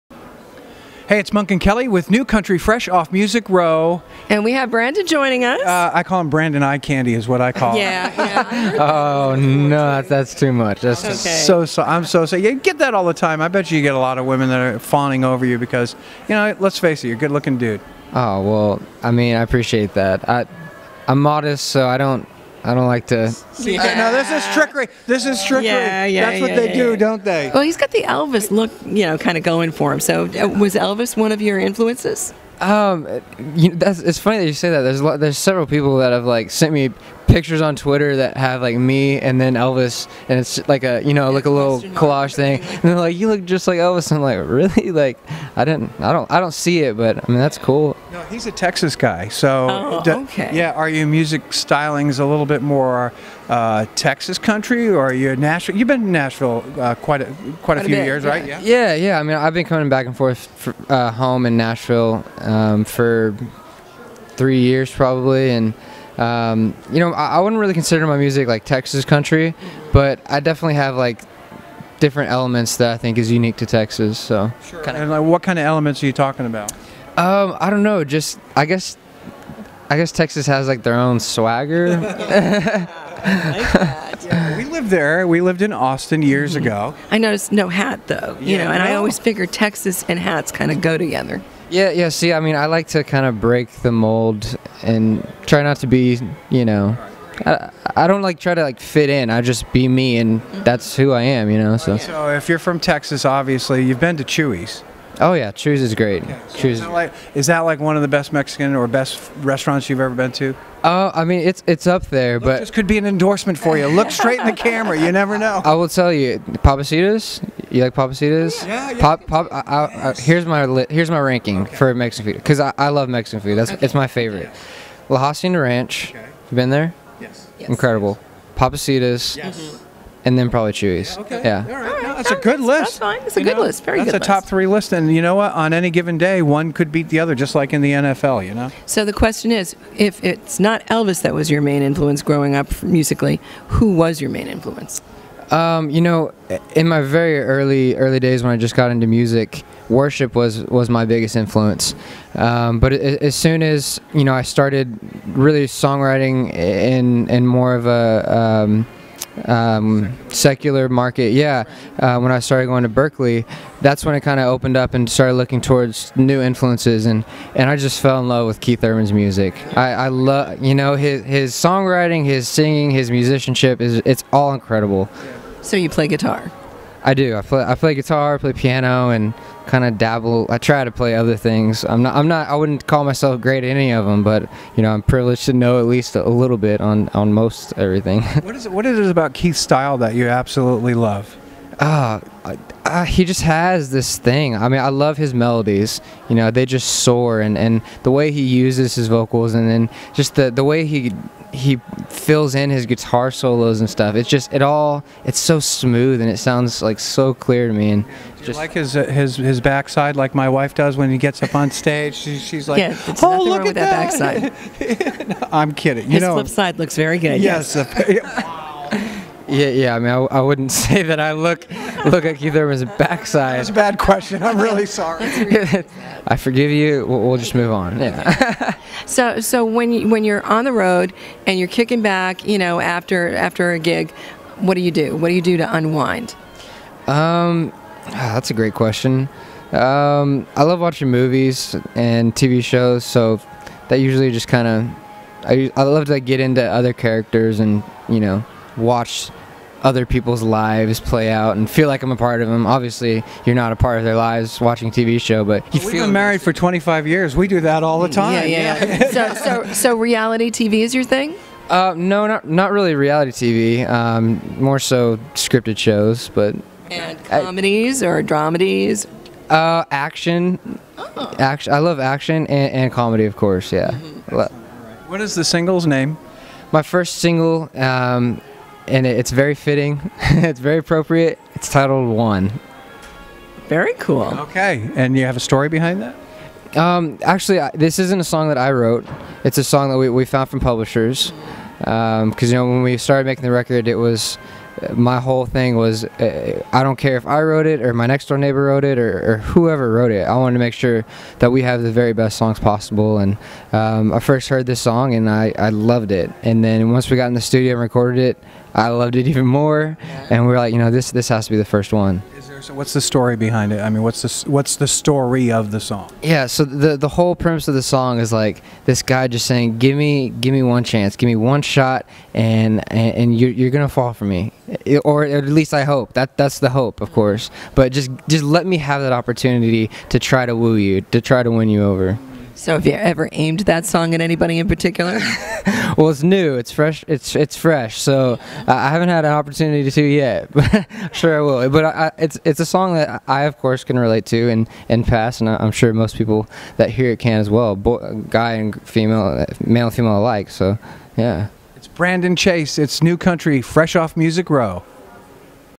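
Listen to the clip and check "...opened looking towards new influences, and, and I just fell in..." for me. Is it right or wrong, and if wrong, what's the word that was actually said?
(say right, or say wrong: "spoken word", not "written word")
wrong: "started", not "opened".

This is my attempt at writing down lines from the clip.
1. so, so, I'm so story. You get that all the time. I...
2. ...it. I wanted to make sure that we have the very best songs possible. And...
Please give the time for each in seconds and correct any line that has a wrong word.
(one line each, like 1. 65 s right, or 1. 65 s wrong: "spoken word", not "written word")
1. 11 s wrong: "sorry", not "story"
2. 300 s right.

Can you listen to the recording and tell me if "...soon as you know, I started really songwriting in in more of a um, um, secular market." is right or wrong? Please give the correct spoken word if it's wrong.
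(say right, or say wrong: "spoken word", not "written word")
right.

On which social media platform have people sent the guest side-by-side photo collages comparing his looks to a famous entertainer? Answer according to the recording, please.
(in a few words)
Twitter.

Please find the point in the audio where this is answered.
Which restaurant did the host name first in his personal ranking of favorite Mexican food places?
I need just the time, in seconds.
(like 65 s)
125 s.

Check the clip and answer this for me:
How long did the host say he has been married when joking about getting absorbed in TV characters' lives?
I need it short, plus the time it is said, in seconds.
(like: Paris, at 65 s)
25 years, at 256 s.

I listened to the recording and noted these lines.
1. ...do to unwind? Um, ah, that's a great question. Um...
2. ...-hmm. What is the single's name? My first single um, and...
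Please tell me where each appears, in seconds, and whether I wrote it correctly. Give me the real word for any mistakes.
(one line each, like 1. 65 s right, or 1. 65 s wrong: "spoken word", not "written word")
1. 235 s right
2. 274 s right.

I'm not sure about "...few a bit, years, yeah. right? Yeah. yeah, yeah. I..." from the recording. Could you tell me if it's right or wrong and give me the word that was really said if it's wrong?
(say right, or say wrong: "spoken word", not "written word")
right.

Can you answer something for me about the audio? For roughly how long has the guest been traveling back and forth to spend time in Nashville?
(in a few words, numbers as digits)
3 years.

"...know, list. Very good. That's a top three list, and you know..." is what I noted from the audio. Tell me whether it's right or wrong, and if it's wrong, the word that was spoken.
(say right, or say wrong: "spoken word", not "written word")
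right.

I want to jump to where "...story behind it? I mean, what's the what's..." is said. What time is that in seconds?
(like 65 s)
313 s.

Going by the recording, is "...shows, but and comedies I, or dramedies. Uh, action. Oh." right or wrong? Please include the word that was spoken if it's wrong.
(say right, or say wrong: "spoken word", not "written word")
right.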